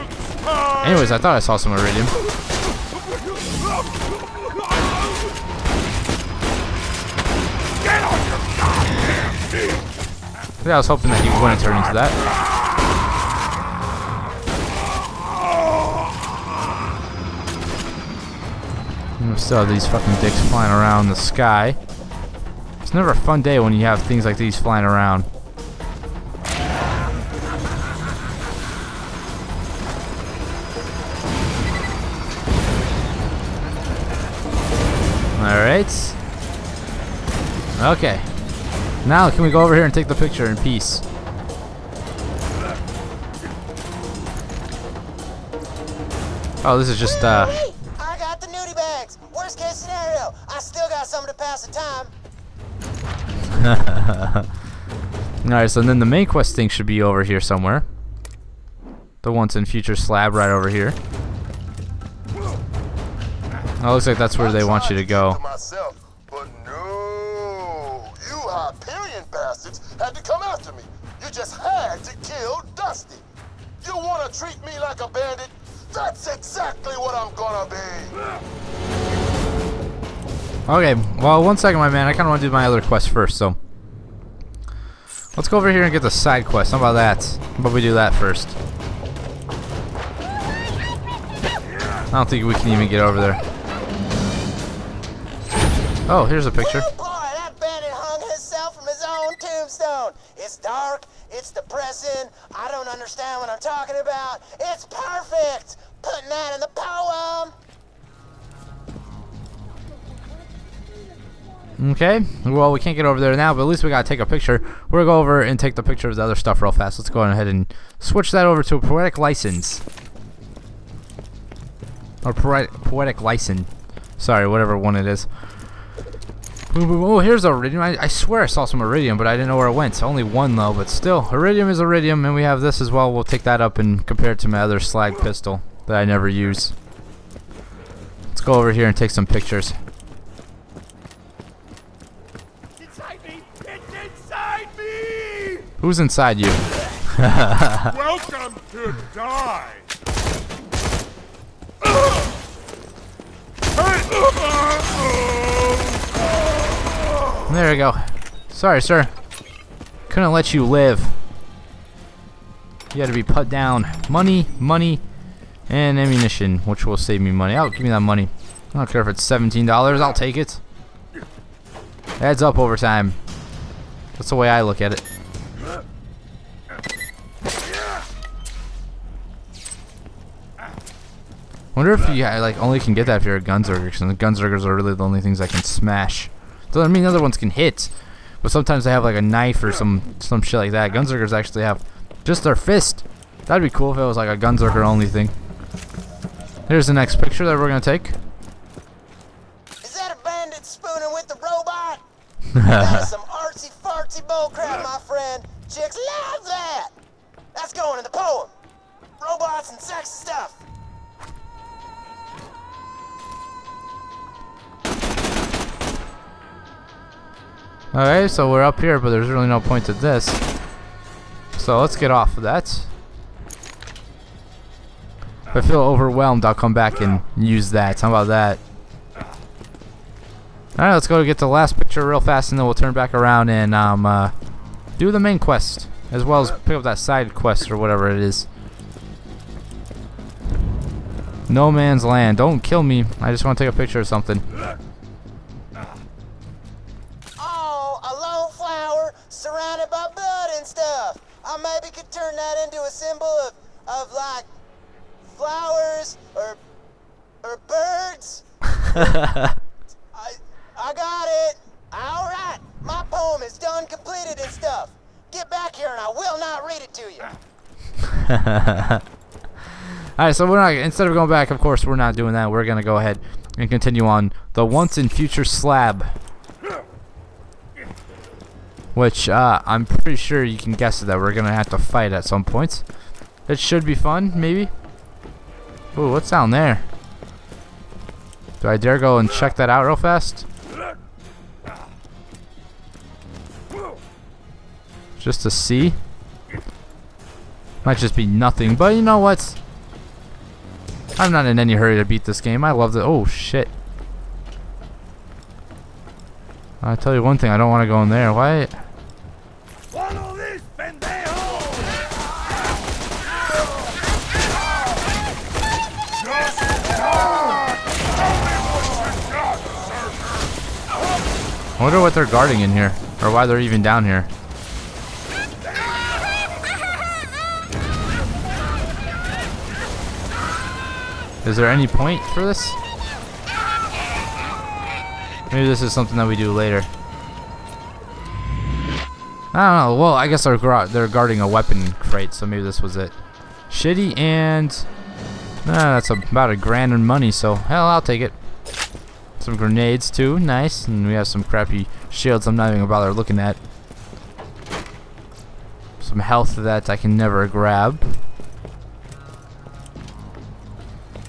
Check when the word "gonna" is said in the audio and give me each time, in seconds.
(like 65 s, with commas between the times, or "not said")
77 s, 115 s, 197 s, 272 s, 281 s, 352 s.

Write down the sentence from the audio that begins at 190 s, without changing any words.
Gunzerkers actually have just their fist.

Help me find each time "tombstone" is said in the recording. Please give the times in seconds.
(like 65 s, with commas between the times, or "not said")
99 s.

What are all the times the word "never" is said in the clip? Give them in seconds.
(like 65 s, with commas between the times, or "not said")
22 s, 136 s, 357 s.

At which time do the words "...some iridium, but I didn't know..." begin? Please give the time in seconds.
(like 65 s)
128 s.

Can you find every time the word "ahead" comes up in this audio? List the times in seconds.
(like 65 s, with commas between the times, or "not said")
117 s, 272 s.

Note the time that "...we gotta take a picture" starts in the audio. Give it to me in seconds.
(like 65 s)
113 s.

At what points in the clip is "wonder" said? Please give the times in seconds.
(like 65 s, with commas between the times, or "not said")
181 s, 321 s.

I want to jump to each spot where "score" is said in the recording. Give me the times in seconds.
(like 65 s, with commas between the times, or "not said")
not said.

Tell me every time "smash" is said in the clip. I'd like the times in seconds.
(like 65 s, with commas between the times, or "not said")
185 s.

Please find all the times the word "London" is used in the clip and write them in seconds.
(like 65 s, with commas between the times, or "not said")
not said.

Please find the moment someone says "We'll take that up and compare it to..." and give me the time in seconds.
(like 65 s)
133 s.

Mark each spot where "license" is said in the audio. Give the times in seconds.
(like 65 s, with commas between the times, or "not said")
119 s, 123 s.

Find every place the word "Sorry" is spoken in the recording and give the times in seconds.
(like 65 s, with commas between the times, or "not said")
124 s, 158 s.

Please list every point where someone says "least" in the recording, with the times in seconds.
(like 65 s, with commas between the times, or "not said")
113 s.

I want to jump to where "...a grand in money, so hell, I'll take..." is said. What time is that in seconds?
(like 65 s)
346 s.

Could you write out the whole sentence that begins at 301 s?
I'm not in any hurry to beat this game.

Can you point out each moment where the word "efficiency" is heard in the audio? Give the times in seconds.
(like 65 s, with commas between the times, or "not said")
not said.